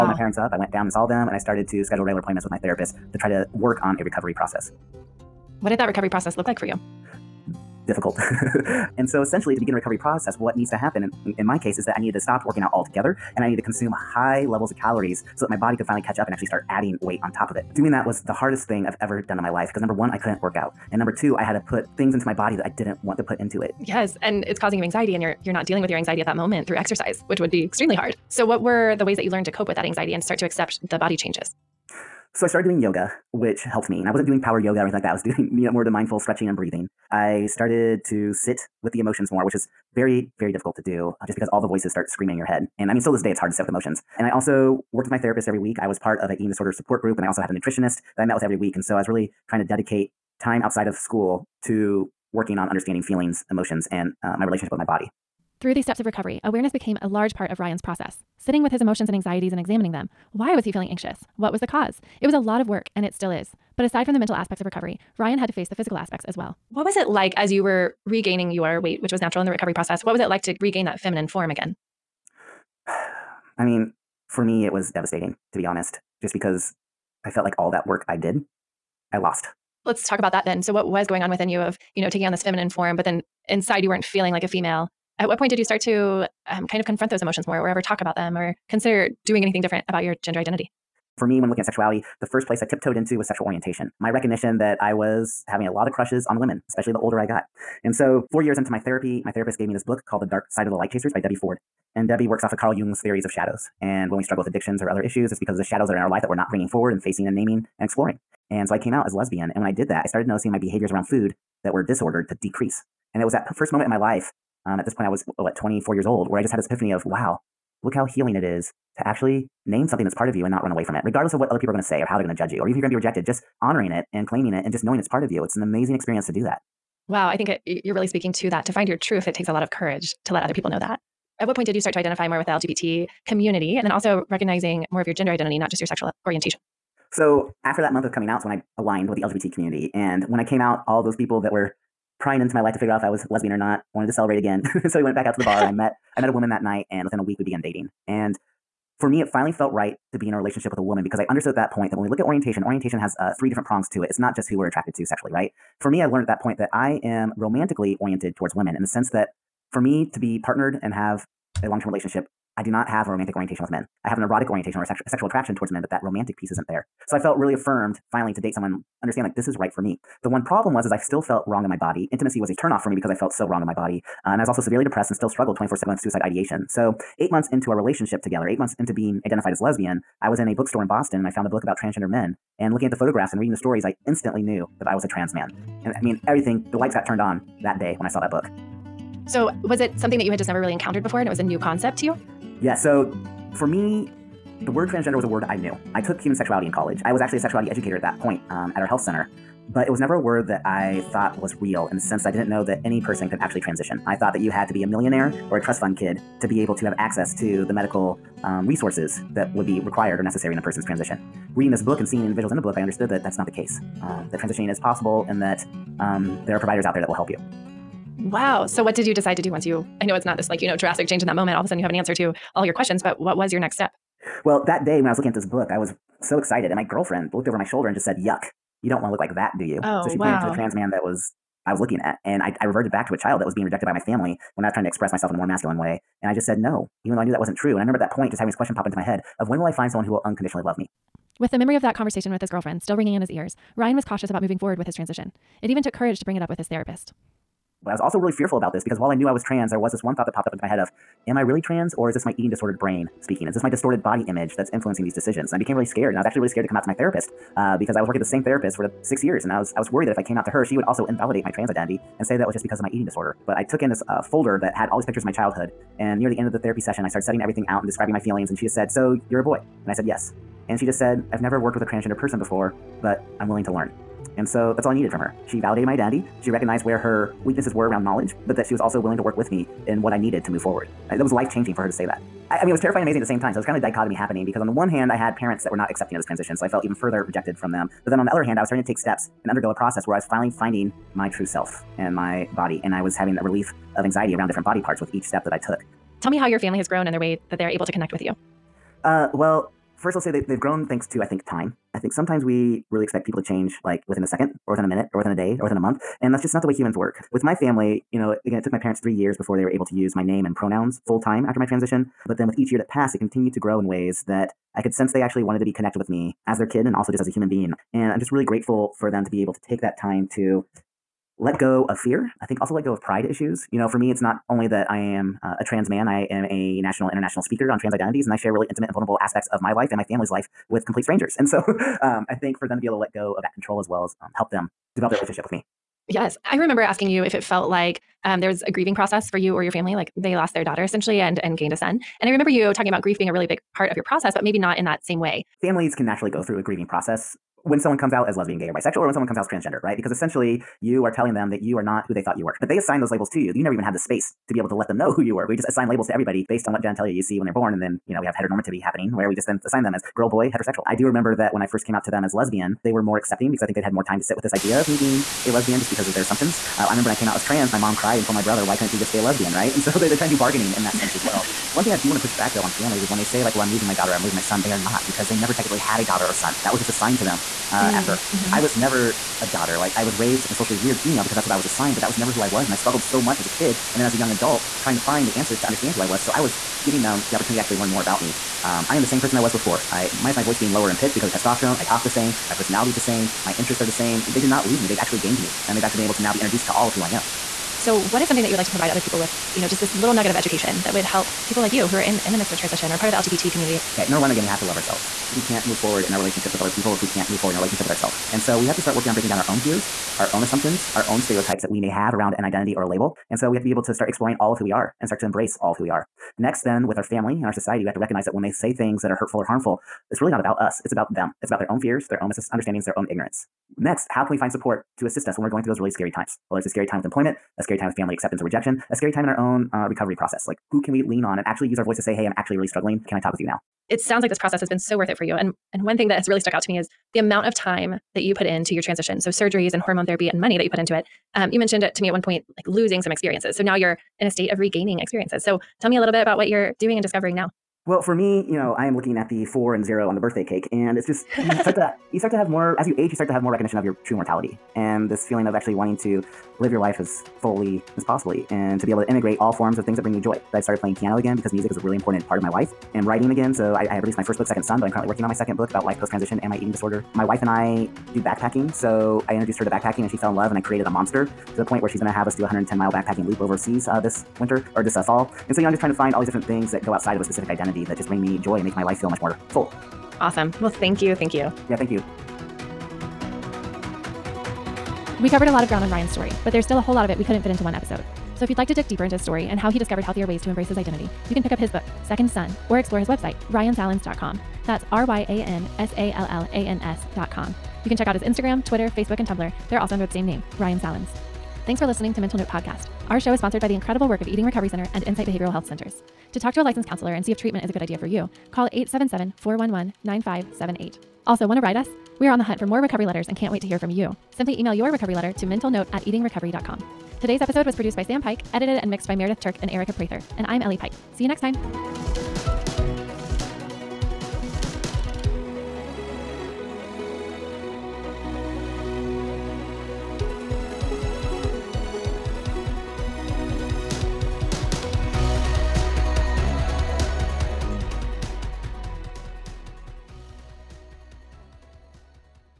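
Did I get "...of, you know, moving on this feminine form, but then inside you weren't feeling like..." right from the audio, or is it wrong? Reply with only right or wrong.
wrong.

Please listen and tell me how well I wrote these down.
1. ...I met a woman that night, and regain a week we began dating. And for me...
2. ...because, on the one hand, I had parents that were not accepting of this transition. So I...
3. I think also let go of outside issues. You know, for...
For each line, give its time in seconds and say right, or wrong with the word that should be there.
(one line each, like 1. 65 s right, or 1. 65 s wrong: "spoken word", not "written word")
1. 146 s wrong: "within", not "regain"
2. 284 s right
3. 322 s wrong: "pride", not "outside".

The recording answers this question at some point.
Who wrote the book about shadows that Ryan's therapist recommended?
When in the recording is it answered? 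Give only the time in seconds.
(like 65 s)
101 s.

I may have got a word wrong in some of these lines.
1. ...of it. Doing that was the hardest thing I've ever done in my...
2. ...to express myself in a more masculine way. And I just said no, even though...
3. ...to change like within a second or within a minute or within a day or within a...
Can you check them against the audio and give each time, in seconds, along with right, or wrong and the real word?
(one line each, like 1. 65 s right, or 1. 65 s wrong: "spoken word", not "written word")
1. 17 s right
2. 234 s right
3. 303 s right.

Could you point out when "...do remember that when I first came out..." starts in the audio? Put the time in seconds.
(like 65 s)
360 s.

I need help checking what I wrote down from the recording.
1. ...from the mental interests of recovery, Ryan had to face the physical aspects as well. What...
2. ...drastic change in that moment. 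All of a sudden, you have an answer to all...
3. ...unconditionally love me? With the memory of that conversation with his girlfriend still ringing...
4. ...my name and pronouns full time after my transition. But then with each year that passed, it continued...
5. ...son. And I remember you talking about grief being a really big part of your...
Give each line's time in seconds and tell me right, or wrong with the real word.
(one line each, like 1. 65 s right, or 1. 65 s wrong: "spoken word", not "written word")
1. 64 s wrong: "aspects", not "interests"
2. 220 s right
3. 240 s right
4. 310 s right
5. 341 s right.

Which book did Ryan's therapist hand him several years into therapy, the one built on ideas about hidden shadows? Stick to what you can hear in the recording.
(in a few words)
The Dark Side of the Light Chasers.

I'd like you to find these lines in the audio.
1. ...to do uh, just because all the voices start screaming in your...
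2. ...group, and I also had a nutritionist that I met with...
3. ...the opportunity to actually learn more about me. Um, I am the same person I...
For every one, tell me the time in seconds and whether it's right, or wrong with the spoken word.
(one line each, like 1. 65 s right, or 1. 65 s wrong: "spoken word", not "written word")
1. 40 s right
2. 47 s right
3. 387 s right.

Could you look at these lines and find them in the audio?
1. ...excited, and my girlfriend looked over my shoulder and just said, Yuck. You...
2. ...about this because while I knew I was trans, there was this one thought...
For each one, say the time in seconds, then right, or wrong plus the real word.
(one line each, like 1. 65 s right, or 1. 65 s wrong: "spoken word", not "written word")
1. 226 s right
2. 248 s right.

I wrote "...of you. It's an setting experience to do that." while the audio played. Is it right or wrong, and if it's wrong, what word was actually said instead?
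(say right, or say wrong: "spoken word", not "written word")
wrong: "amazing", not "setting".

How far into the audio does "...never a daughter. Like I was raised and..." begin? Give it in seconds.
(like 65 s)
378 s.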